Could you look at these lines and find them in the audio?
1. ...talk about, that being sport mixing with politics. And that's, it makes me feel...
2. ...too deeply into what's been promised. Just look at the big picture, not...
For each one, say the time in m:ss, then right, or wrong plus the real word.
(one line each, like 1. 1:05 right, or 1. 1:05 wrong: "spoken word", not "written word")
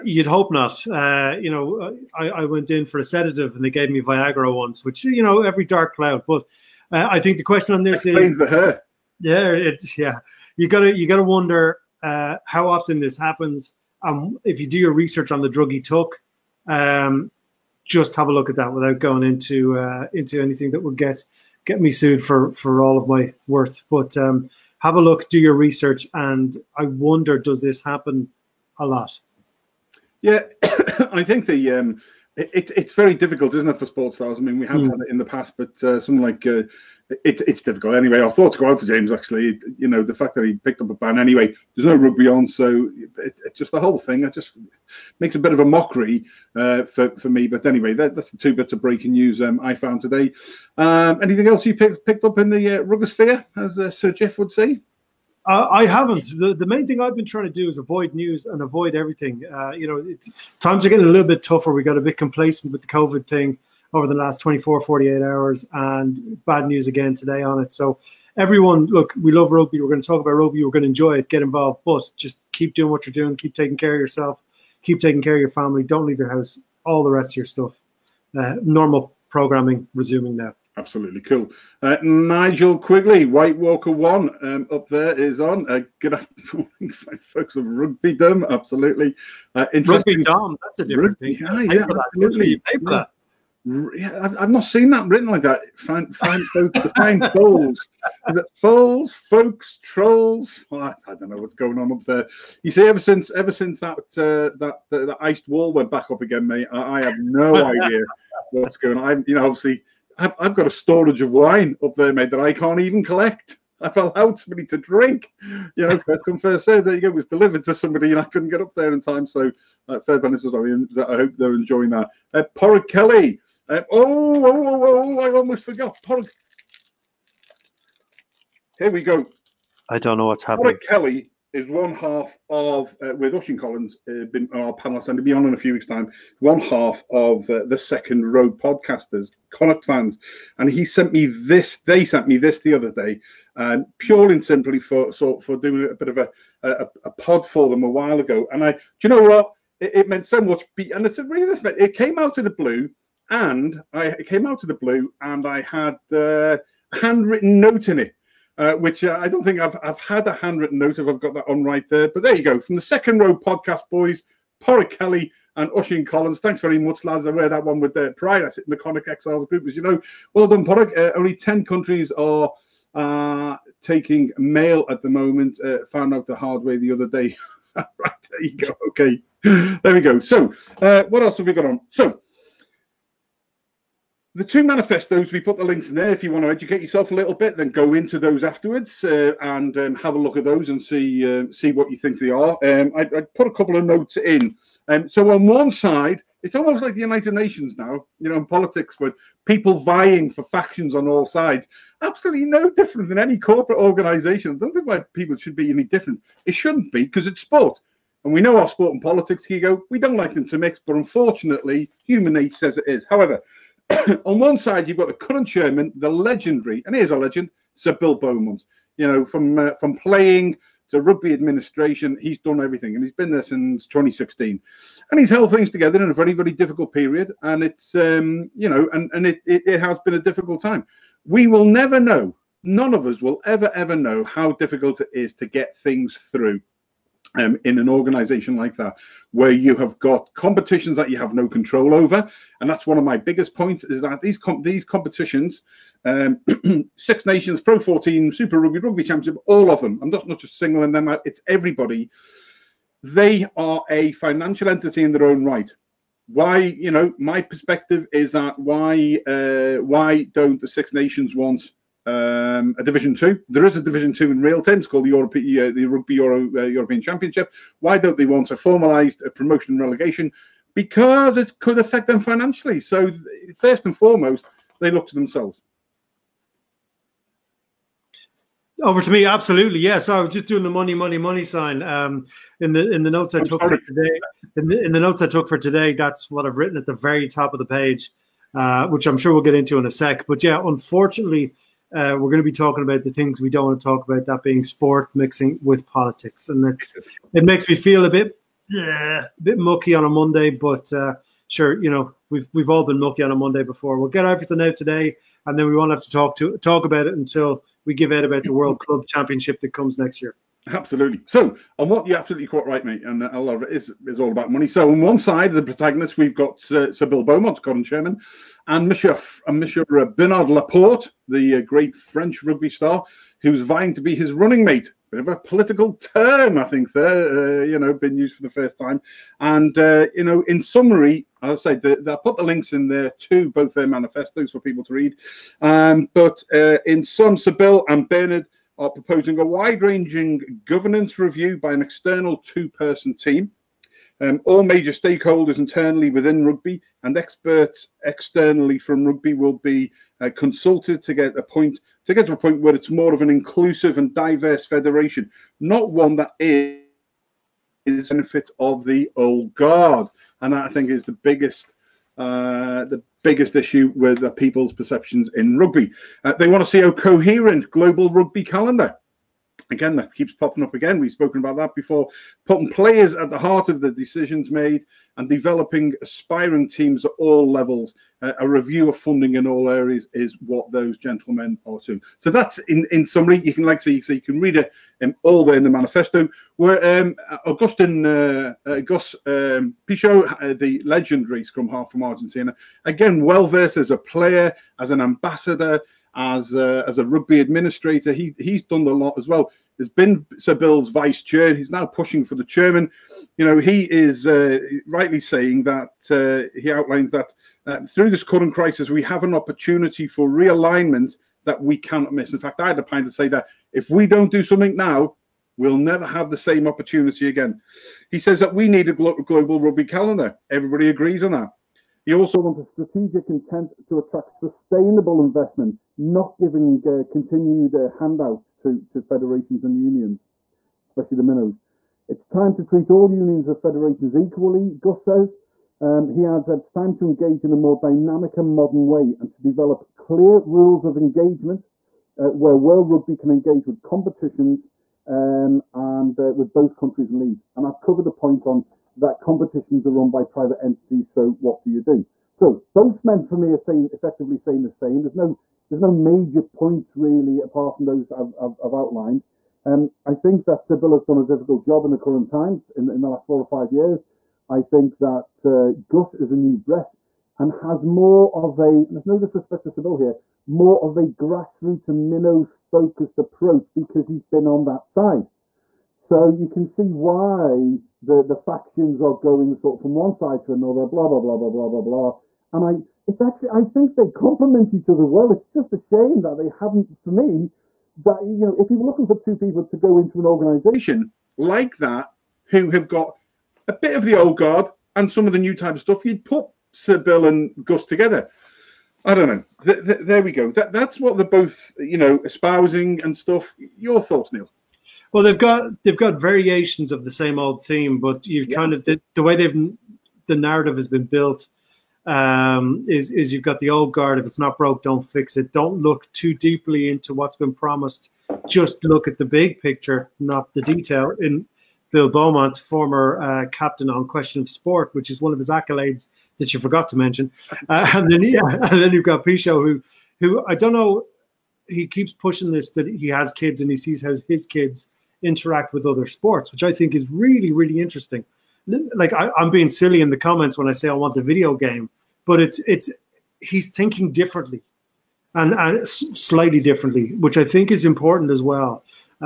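1. 4:53 right
2. 8:36 right.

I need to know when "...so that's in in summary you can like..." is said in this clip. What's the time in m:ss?
6:22.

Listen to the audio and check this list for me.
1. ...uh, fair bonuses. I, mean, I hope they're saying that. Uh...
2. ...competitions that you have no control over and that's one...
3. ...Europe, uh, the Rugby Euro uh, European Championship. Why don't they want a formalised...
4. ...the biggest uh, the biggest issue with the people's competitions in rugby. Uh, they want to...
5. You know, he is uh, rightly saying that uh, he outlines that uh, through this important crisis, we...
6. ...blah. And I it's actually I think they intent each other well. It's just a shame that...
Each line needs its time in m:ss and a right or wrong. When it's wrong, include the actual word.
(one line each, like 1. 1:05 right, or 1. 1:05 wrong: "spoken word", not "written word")
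1. 1:59 wrong: "enjoying", not "saying"
2. 4:00 right
3. 4:25 right
4. 6:01 wrong: "perceptions", not "competitions"
5. 6:43 wrong: "current", not "important"
6. 8:01 wrong: "complement", not "intent".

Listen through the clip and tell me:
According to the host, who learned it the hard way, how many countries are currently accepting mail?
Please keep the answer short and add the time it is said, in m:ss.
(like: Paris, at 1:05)
10, at 2:51.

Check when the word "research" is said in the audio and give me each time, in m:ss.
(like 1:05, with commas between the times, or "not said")
0:14, 0:25.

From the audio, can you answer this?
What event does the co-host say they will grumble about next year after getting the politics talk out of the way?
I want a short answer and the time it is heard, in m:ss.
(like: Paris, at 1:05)
World Club Championship, at 5:08.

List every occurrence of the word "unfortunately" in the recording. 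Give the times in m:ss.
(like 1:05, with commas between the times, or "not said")
3:30, 4:50.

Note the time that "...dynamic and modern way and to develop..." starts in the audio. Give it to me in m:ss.
7:17.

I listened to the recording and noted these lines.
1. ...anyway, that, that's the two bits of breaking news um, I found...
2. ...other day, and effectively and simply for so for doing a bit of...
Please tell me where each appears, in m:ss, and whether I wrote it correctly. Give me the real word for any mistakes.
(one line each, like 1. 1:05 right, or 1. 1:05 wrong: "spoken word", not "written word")
1. 0:47 right
2. 2:22 wrong: "purely", not "effectively".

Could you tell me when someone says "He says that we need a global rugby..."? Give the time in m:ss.
6:58.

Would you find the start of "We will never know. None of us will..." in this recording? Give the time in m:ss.
3:51.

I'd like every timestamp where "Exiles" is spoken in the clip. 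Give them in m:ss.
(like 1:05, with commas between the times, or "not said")
2:49.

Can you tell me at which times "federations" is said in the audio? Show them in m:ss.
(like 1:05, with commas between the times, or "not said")
5:54, 7:09, 7:13.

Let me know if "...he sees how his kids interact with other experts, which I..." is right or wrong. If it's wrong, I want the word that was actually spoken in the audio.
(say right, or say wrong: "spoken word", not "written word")
wrong: "sports", not "experts".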